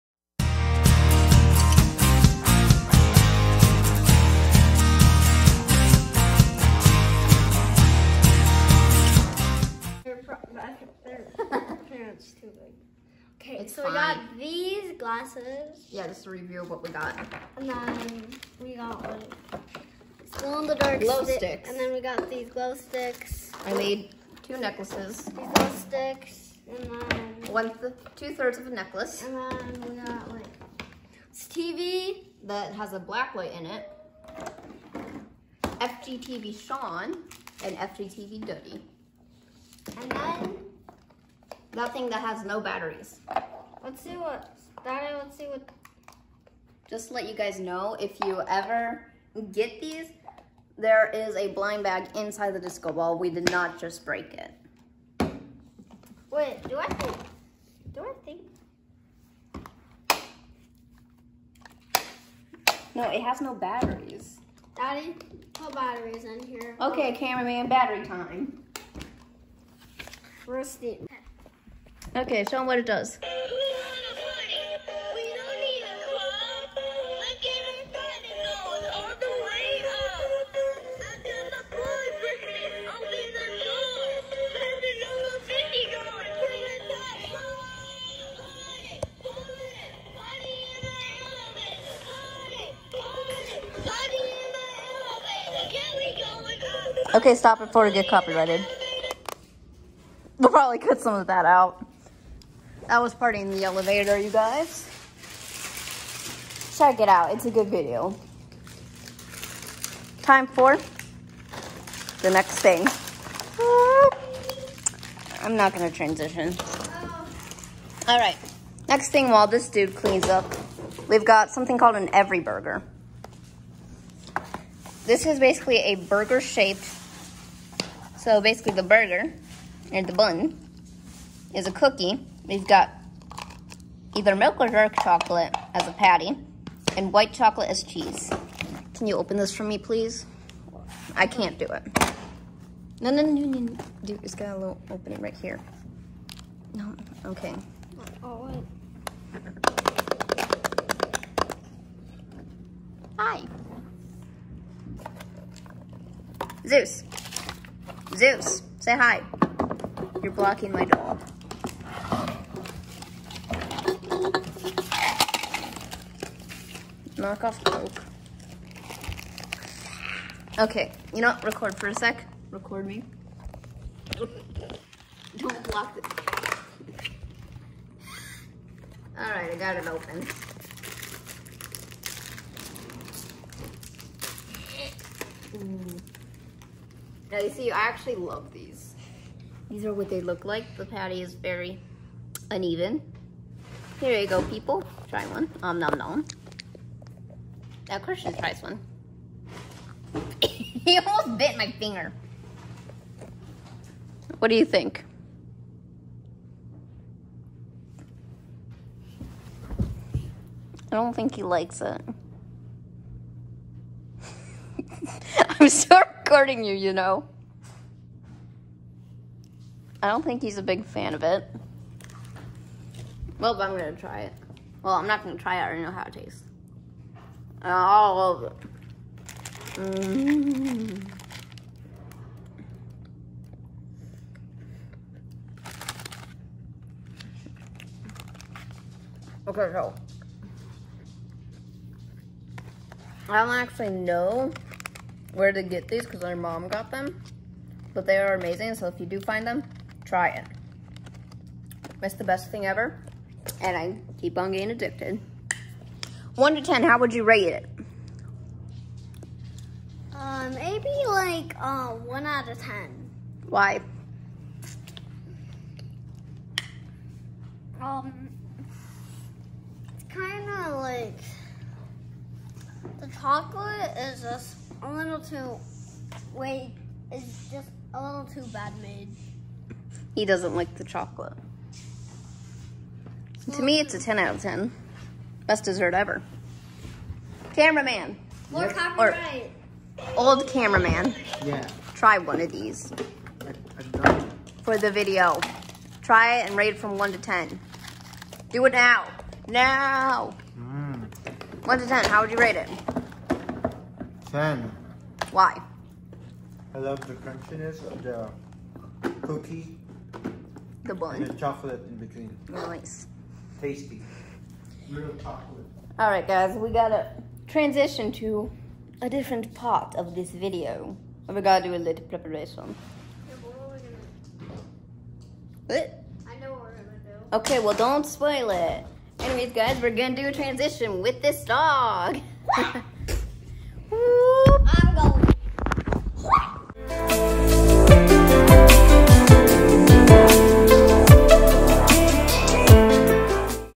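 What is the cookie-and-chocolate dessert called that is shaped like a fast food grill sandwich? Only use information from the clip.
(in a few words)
every burger.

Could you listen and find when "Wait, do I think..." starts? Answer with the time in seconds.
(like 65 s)
56 s.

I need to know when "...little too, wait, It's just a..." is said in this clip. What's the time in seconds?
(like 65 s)
274 s.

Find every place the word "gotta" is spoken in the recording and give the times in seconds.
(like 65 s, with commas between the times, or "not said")
316 s, 321 s.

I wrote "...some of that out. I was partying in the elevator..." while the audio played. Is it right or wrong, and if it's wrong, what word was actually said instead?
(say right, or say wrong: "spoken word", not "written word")
right.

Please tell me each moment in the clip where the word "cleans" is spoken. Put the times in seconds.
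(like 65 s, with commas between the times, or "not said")
119 s.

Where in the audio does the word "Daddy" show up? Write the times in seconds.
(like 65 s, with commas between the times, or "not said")
44 s, 64 s.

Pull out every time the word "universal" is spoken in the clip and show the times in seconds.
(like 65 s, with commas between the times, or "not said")
not said.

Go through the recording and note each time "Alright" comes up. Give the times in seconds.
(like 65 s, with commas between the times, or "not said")
179 s, 315 s.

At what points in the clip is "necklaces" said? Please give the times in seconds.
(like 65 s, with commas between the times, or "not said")
24 s, 28 s.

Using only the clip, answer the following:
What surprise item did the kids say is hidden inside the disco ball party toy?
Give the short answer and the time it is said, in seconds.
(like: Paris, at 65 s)
a blind bag, at 51 s.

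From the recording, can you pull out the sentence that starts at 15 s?
Yeah, just a review of what we got.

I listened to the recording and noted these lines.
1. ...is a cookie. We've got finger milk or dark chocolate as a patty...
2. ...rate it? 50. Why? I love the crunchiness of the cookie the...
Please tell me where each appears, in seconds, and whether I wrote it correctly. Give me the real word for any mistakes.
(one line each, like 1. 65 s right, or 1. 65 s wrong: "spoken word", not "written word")
1. 131 s wrong: "either", not "finger"
2. 302 s wrong: "10", not "50".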